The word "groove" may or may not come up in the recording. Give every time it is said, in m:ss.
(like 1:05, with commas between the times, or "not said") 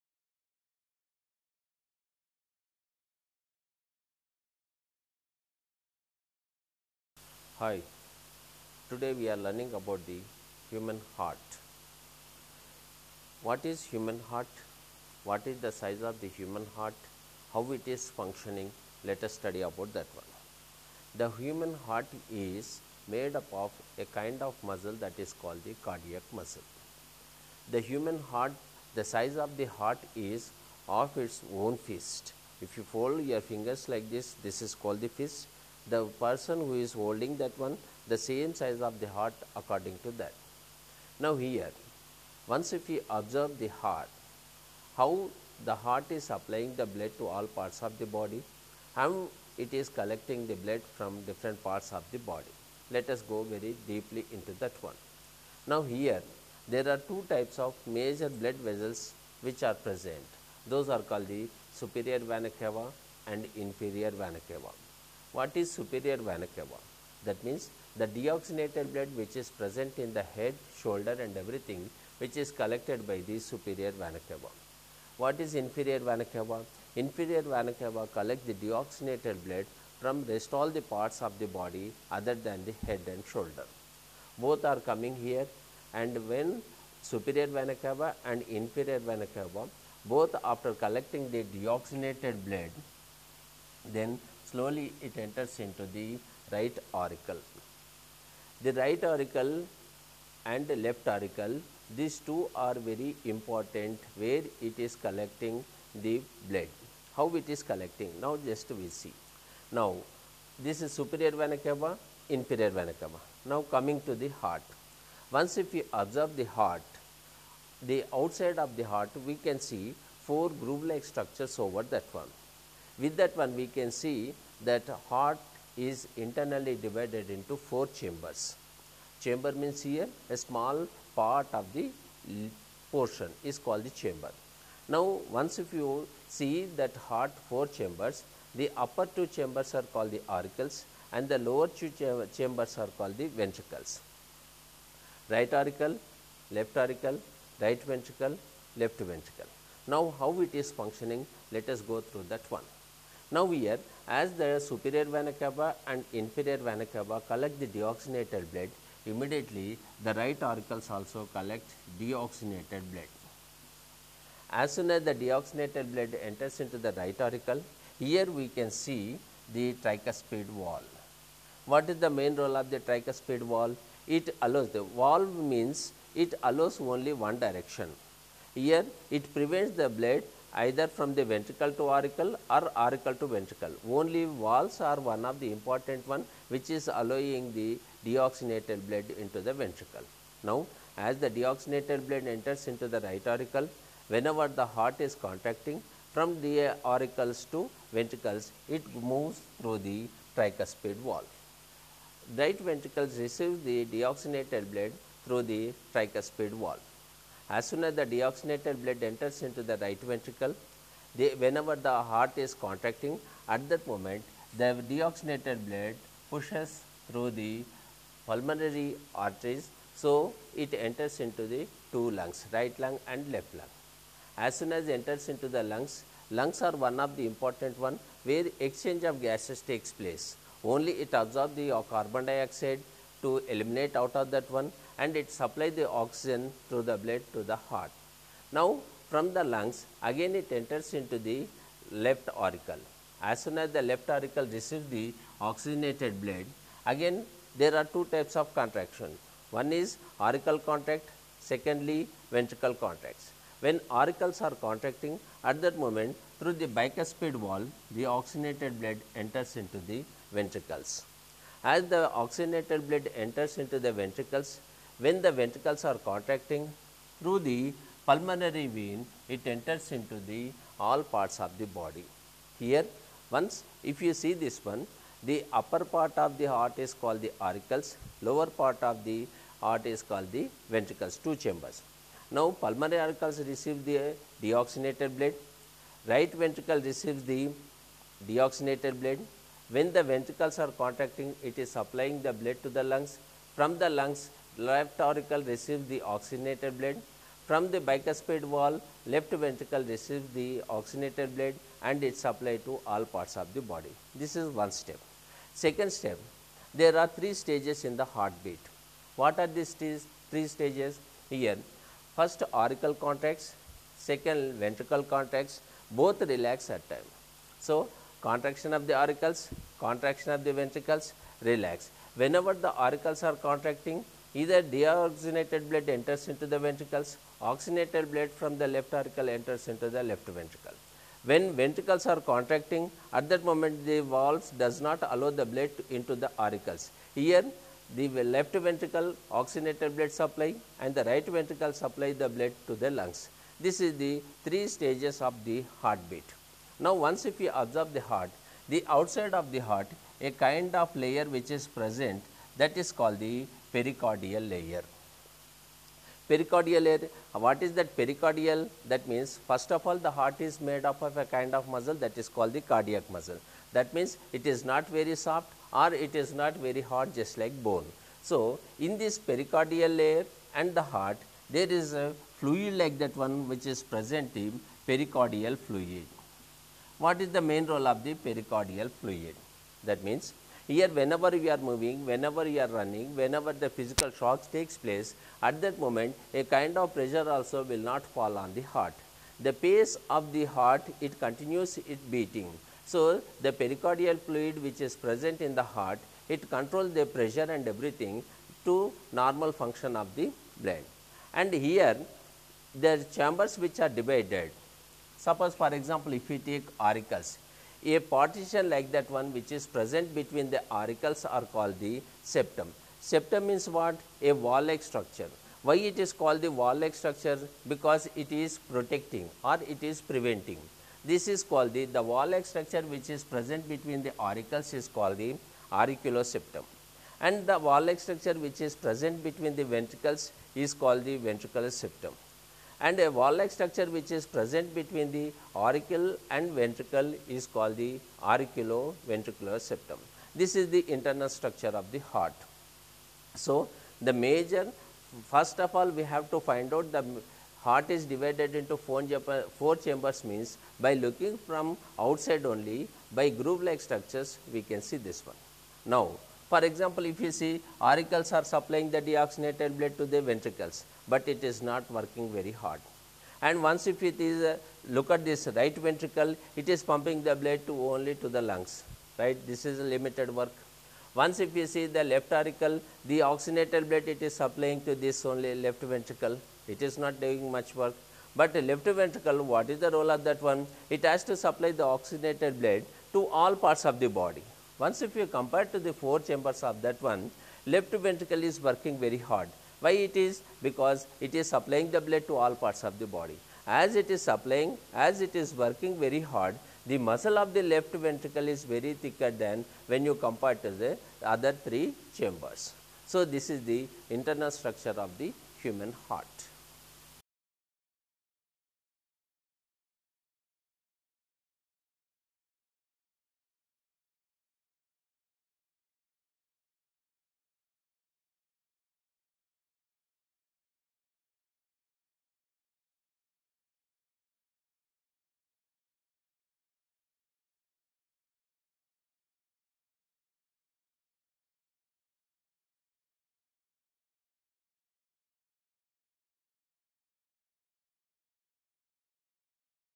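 2:00, 7:33.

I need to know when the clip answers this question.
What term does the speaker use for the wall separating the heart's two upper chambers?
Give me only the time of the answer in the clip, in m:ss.
7:05.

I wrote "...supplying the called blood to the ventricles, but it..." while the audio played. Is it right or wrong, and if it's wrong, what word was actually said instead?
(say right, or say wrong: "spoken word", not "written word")
wrong: "deoxygenated", not "called".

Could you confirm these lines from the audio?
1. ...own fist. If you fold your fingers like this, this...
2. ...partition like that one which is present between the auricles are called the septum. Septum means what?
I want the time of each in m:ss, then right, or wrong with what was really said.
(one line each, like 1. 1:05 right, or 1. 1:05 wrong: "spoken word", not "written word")
1. 0:31 right
2. 6:47 right.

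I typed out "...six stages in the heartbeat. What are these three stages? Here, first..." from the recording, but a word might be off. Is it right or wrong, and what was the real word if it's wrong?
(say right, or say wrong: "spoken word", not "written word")
wrong: "three", not "six".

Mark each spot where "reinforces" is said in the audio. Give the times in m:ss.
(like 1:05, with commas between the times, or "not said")
not said.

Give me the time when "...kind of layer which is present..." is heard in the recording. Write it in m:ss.
5:50.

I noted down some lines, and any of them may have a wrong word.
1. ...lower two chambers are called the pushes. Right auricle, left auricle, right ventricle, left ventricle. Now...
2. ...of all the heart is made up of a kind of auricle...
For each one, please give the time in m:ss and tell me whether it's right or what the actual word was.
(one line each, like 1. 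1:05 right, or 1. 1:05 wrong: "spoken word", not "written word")
1. 2:21 wrong: "ventricles", not "pushes"
2. 5:59 wrong: "muscle", not "auricle".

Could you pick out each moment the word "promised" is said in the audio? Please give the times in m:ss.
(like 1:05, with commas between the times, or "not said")
not said.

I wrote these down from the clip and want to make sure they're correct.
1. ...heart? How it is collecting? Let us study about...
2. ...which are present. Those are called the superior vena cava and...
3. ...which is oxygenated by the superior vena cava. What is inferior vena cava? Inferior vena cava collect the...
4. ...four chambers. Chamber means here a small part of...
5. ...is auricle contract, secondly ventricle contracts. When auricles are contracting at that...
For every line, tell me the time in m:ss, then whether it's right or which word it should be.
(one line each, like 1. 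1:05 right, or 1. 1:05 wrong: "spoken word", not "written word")
1. 0:16 wrong: "functioning", not "collecting"
2. 0:59 right
3. 1:12 wrong: "collected", not "oxygenated"
4. 2:07 right
5. 4:09 right.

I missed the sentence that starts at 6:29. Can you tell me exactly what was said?
The pace of the heart, it continues its beating.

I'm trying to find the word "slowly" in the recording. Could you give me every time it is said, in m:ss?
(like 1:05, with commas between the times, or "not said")
1:34.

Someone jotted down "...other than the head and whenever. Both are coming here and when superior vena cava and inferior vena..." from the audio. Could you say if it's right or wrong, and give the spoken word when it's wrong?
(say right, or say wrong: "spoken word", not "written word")
wrong: "shoulder", not "whenever".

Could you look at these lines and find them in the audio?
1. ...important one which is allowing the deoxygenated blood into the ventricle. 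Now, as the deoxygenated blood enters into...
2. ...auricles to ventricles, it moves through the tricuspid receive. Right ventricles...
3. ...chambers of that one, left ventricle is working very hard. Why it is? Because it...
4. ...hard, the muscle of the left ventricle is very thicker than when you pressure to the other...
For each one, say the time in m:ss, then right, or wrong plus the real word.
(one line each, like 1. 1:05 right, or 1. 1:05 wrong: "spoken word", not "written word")
1. 3:05 right
2. 3:16 wrong: "valve", not "receive"
3. 8:06 right
4. 8:16 wrong: "compare", not "pressure".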